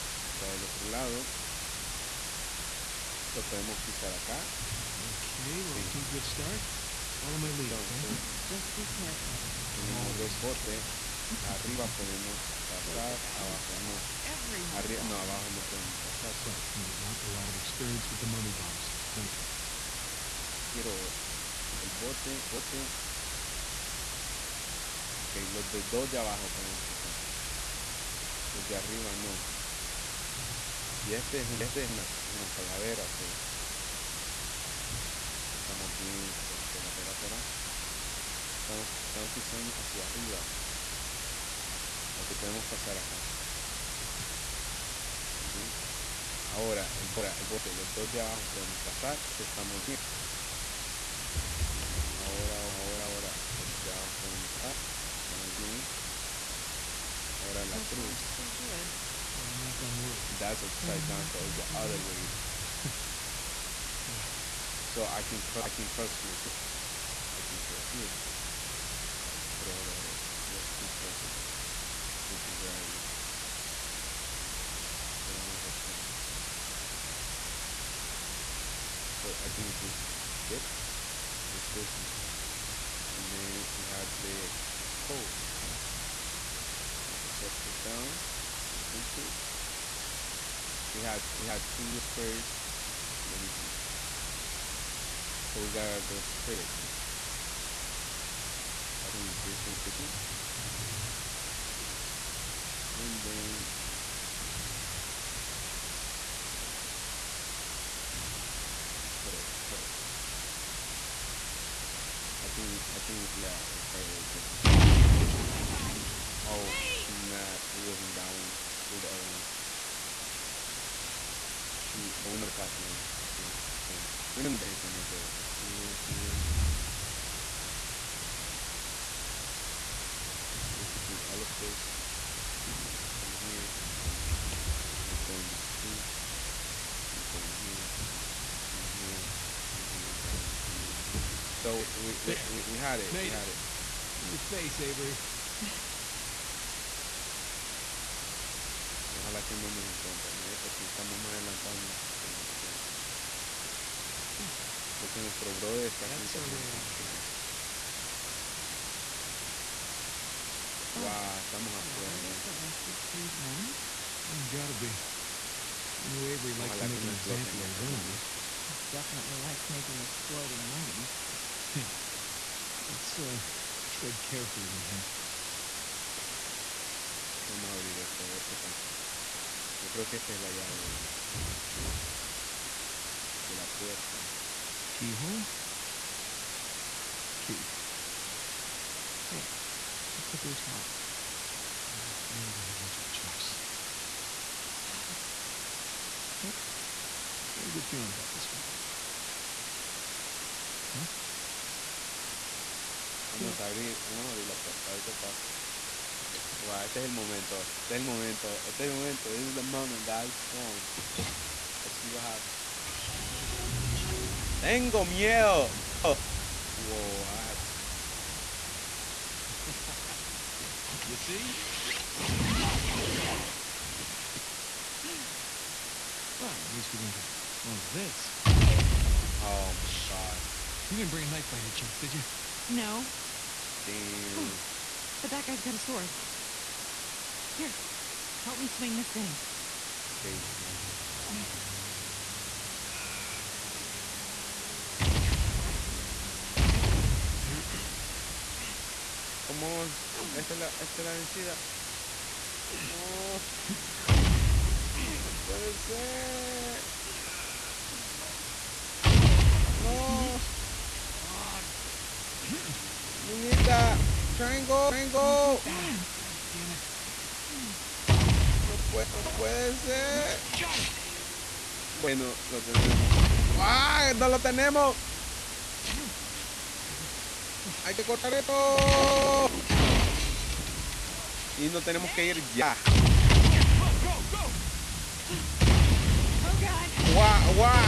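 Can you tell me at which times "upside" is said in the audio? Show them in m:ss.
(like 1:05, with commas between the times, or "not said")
1:00, 1:15, 1:27.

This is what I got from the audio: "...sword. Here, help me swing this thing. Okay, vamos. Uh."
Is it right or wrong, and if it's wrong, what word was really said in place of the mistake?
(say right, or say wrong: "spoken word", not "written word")
right.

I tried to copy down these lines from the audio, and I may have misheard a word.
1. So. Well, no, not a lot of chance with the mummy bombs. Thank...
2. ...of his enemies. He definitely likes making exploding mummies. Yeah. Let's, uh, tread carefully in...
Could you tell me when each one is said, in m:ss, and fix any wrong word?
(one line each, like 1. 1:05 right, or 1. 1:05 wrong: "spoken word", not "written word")
1. 0:16 wrong: "experience", not "chance"
2. 2:47 right.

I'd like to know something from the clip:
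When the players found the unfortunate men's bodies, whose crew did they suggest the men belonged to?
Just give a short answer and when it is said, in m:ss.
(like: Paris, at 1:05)
Tew, at 2:43.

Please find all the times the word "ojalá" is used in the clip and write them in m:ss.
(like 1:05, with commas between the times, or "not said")
2:29, 2:46.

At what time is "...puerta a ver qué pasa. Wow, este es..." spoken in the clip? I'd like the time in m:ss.
3:24.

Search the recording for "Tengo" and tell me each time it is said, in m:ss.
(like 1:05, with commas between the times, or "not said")
3:34.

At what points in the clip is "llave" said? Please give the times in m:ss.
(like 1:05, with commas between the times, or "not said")
3:00.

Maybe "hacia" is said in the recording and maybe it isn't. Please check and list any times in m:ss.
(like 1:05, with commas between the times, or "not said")
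0:39.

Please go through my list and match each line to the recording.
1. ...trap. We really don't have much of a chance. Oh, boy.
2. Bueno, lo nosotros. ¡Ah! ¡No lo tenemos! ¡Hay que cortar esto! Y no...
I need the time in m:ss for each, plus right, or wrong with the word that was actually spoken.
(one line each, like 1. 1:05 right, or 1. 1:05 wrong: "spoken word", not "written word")
1. 3:10 wrong: "choice", not "chance"
2. 4:32 wrong: "tenemos", not "nosotros".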